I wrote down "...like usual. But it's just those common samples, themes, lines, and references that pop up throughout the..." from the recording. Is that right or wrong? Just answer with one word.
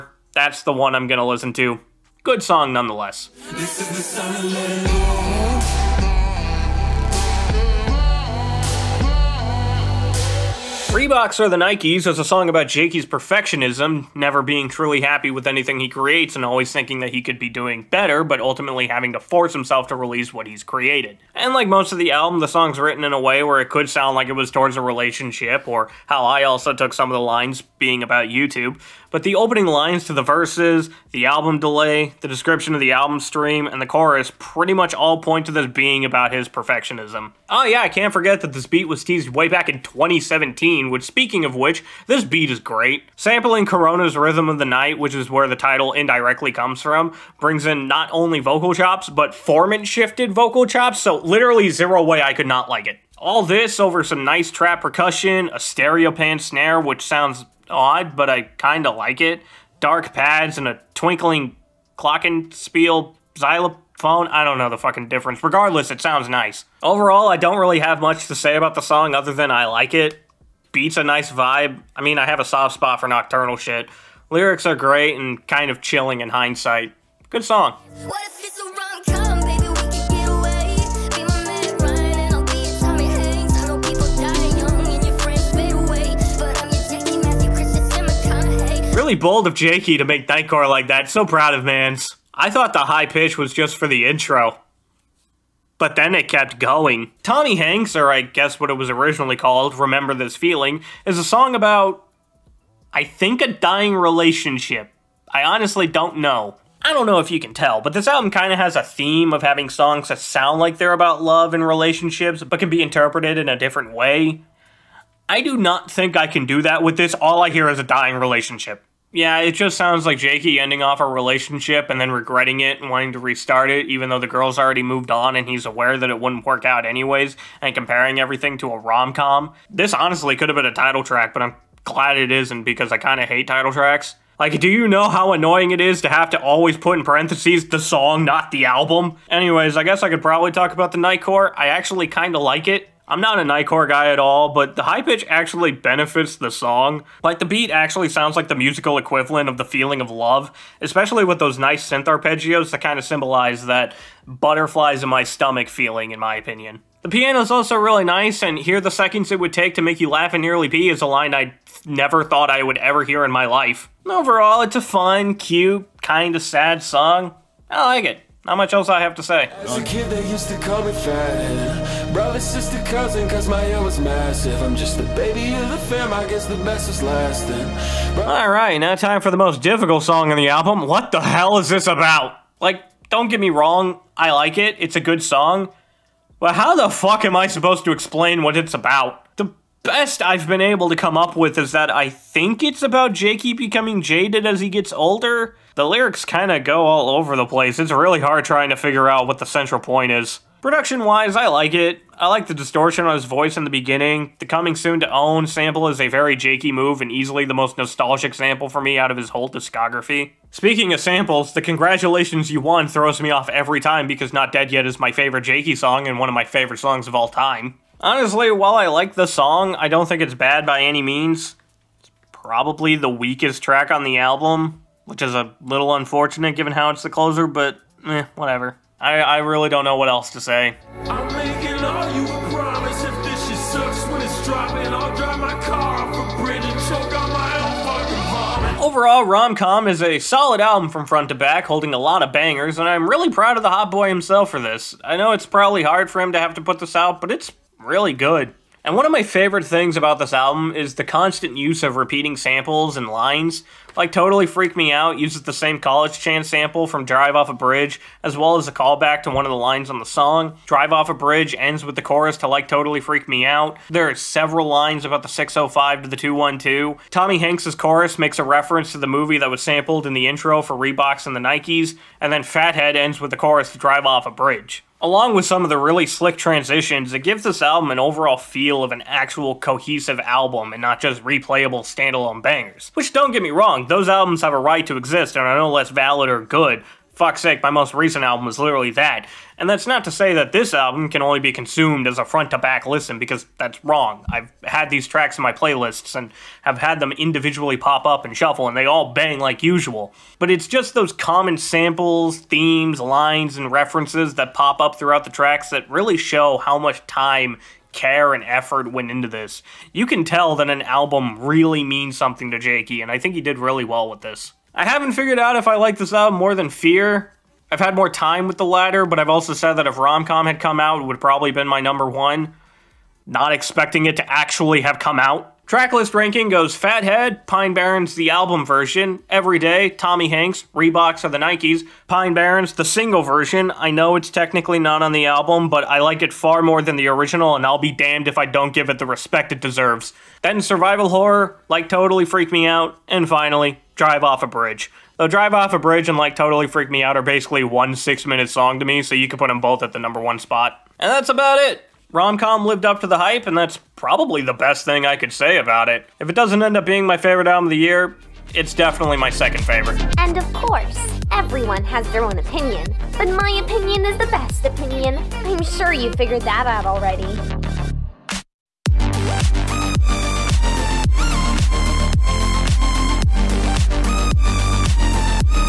right.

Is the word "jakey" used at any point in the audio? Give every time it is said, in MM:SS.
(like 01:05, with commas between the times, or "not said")
00:12, 01:29, 02:00, 03:13, 03:26, 03:35, 05:12.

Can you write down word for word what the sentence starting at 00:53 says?
All this over some nice trap percussion, a stereo pan snare, which sounds odd, but I kind of like it.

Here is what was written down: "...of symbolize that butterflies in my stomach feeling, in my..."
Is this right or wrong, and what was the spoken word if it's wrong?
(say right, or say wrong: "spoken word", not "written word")
right.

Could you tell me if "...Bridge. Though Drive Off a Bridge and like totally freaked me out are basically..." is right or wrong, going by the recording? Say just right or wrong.
right.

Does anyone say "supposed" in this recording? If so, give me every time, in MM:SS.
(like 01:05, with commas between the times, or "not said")
03:07.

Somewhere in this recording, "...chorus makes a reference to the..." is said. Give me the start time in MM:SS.
04:27.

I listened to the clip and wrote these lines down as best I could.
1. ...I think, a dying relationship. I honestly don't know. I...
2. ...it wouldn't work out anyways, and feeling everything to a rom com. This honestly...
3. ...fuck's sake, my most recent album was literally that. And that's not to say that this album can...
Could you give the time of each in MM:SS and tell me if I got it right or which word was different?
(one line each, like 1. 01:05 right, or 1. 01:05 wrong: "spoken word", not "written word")
1. 01:42 right
2. 02:06 wrong: "comparing", not "feeling"
3. 04:47 right.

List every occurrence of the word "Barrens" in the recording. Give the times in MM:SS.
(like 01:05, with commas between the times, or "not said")
05:27, 05:32.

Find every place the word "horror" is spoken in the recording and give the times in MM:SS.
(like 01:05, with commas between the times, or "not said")
05:41.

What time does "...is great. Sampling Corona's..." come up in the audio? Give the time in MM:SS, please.
00:42.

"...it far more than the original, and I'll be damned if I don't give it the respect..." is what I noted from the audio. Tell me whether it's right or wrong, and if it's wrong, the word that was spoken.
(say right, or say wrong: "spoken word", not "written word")
right.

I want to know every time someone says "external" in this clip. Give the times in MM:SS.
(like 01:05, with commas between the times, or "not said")
not said.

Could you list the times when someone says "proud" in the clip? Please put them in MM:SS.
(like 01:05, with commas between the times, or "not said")
01:31, 04:03.